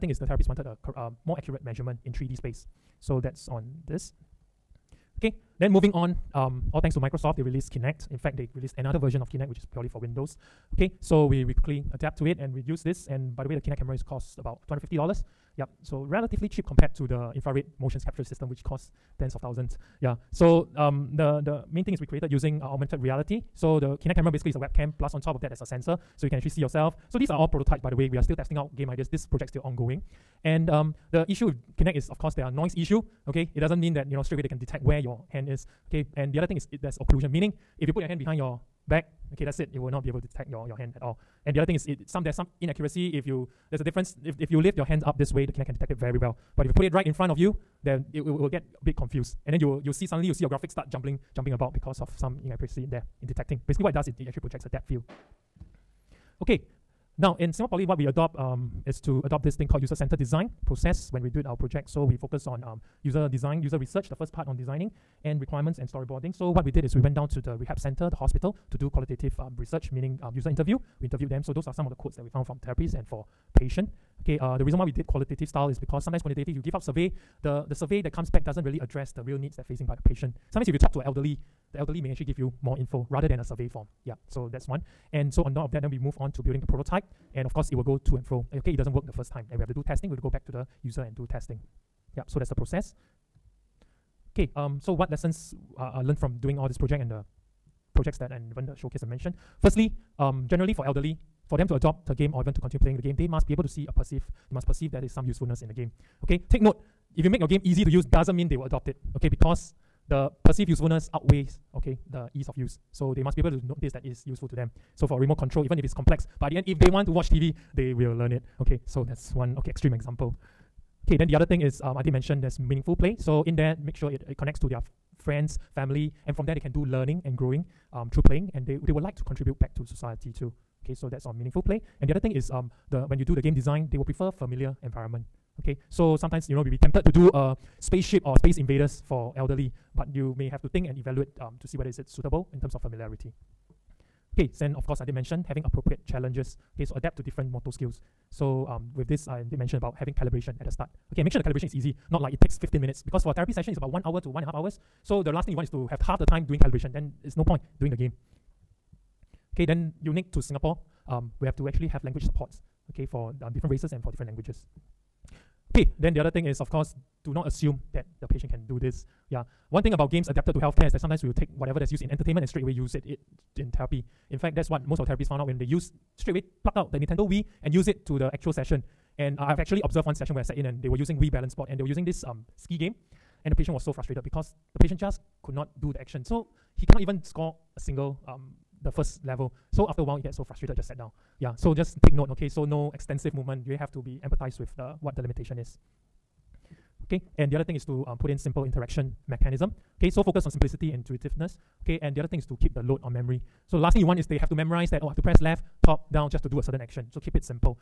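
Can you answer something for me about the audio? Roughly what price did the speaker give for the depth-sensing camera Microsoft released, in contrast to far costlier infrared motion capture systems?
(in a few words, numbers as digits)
$250.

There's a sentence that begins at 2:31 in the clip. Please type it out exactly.
Okay, make sure the calibration is easy, not like it takes 15 minutes.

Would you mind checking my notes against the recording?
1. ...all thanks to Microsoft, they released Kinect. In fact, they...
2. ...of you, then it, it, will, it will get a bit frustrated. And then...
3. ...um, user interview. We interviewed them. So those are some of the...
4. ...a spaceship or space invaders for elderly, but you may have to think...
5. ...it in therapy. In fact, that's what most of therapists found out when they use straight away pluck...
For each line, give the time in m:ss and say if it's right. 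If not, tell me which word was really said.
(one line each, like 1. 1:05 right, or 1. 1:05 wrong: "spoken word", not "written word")
1. 0:06 right
2. 0:47 wrong: "confused", not "frustrated"
3. 1:10 right
4. 2:17 right
5. 2:53 right.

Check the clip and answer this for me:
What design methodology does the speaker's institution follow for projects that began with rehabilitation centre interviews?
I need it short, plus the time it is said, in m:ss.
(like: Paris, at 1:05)
user-centered design, at 0:59.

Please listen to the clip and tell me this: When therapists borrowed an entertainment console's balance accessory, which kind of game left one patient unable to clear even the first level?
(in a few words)
ski game.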